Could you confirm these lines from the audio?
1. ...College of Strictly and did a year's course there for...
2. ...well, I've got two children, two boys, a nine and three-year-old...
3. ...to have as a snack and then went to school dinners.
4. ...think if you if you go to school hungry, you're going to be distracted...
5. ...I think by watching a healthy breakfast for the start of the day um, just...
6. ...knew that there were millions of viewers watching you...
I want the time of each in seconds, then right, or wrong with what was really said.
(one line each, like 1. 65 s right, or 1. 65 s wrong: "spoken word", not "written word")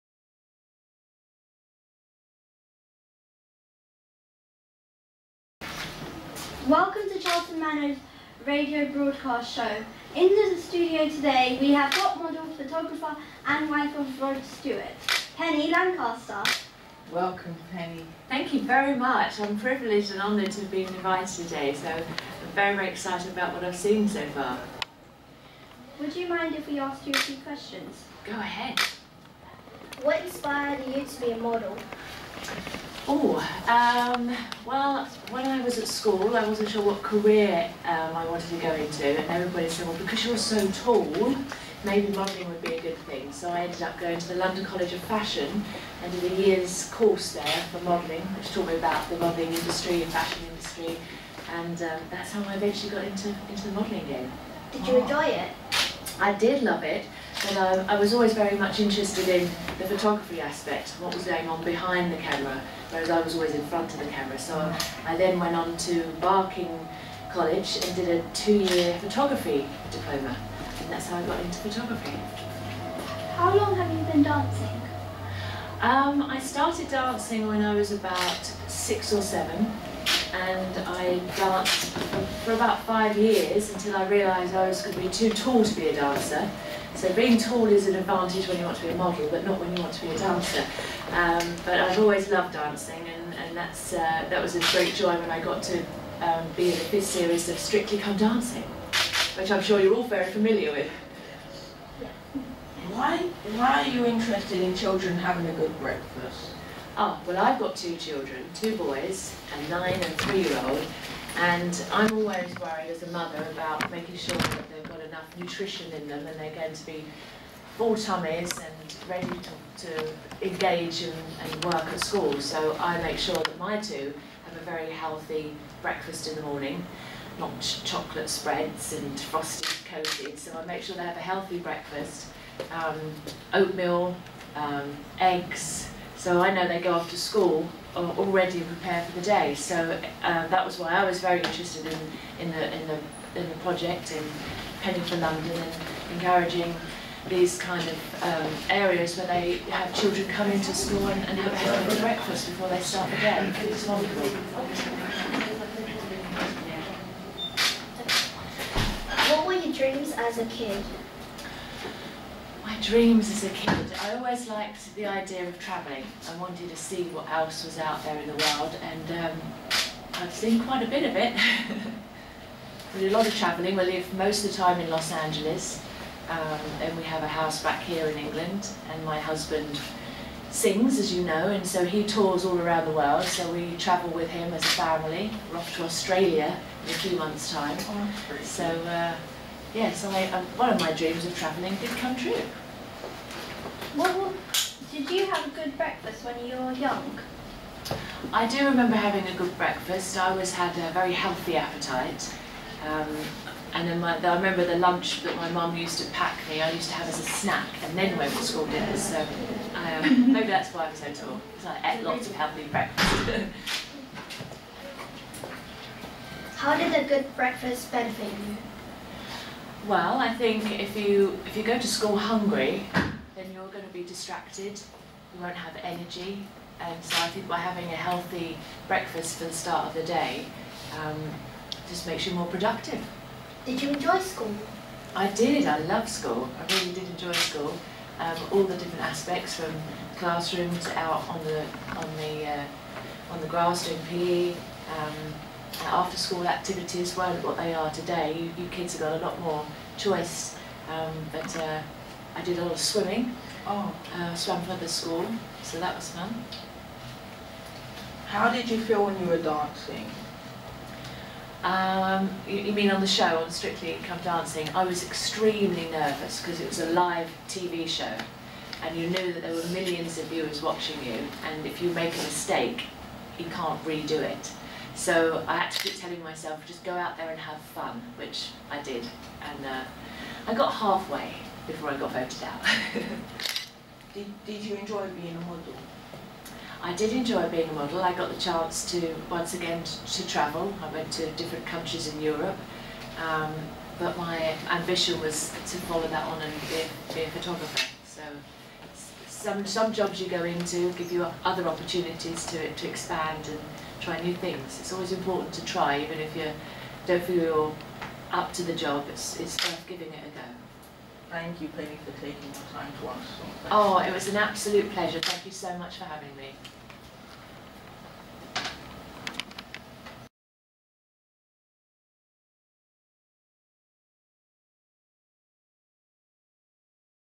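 1. 44 s wrong: "Fashion", not "Strictly"
2. 107 s right
3. 206 s right
4. 220 s right
5. 227 s wrong: "having", not "watching"
6. 269 s right.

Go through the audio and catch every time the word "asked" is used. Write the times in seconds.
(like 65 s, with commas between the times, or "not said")
26 s.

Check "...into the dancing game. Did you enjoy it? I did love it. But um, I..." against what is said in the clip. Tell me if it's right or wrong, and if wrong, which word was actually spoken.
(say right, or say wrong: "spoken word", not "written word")
wrong: "modelling", not "dancing".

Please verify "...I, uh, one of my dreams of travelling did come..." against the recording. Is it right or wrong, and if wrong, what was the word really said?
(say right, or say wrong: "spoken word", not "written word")
right.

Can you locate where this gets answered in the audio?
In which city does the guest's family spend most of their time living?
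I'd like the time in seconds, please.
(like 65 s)
174 s.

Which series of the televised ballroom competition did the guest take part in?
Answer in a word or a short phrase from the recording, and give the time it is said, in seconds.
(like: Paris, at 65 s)
fifth, at 96 s.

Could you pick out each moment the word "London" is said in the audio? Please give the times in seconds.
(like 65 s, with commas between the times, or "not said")
44 s, 145 s.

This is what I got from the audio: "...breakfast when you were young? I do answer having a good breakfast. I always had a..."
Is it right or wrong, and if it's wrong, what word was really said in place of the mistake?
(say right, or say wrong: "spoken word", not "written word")
wrong: "remember", not "answer".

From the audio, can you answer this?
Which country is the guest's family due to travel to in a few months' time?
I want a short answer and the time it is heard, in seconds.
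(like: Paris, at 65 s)
Australia, at 185 s.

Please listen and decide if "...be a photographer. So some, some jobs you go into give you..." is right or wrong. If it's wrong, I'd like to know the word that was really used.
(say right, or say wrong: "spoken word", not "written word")
right.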